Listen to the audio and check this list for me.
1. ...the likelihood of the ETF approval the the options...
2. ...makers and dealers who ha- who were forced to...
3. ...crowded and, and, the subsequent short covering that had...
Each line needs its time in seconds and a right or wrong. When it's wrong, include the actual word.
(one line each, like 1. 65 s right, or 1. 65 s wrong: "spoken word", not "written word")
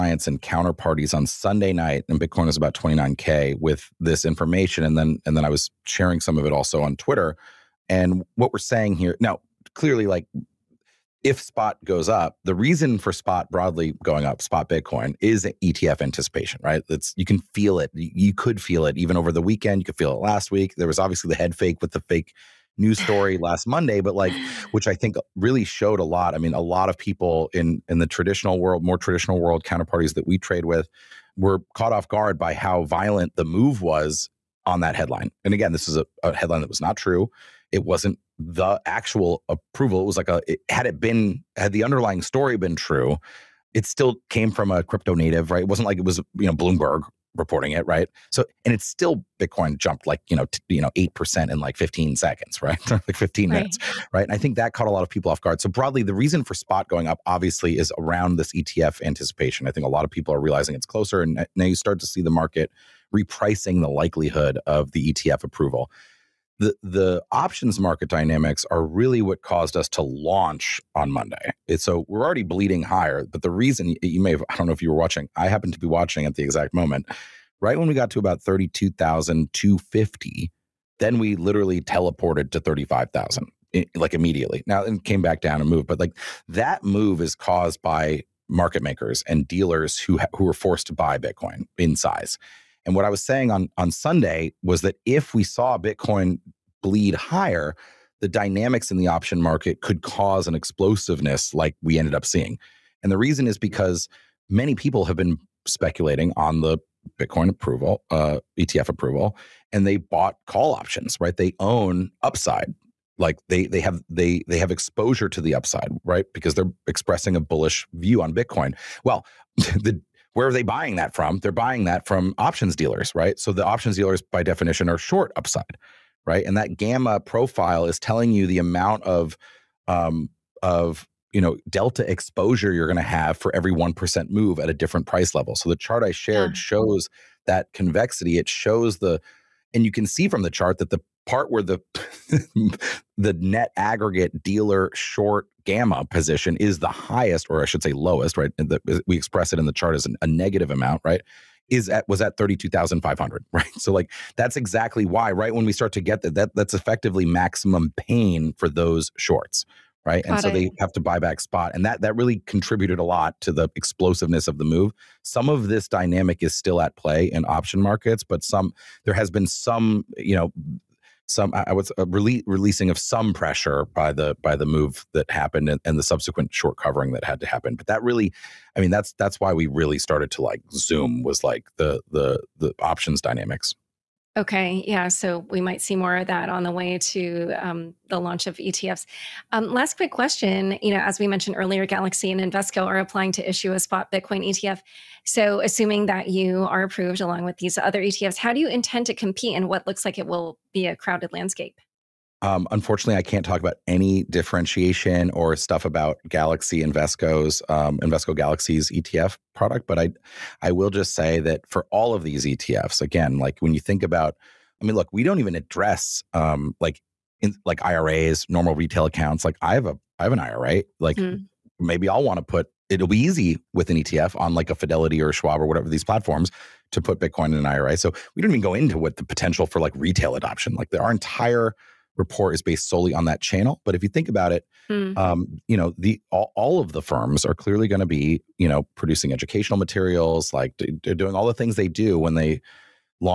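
1. 63 s right
2. 88 s right
3. 175 s wrong: "happened", not "crowded".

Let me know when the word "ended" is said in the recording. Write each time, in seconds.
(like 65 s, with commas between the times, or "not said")
101 s.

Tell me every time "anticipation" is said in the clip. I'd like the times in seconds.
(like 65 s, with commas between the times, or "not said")
16 s, 59 s.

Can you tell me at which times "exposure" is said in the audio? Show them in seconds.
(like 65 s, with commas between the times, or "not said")
114 s, 132 s.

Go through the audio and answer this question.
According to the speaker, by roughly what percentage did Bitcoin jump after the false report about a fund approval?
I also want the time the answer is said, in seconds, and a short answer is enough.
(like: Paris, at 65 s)
8%, at 50 s.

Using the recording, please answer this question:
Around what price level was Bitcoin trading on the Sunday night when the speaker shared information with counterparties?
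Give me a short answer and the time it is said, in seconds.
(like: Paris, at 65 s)
29K, at 2 s.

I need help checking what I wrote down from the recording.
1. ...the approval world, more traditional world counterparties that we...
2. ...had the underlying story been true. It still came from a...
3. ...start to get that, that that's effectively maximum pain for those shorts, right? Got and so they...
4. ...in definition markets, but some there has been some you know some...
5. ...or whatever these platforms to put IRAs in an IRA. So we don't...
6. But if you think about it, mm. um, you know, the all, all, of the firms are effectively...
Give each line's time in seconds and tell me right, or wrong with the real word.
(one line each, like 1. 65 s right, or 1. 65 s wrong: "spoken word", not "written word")
1. 27 s wrong: "traditional", not "approval"
2. 41 s right
3. 155 s right
4. 167 s wrong: "option", not "definition"
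5. 225 s wrong: "Bitcoin", not "IRAs"
6. 233 s wrong: "clearly", not "effectively".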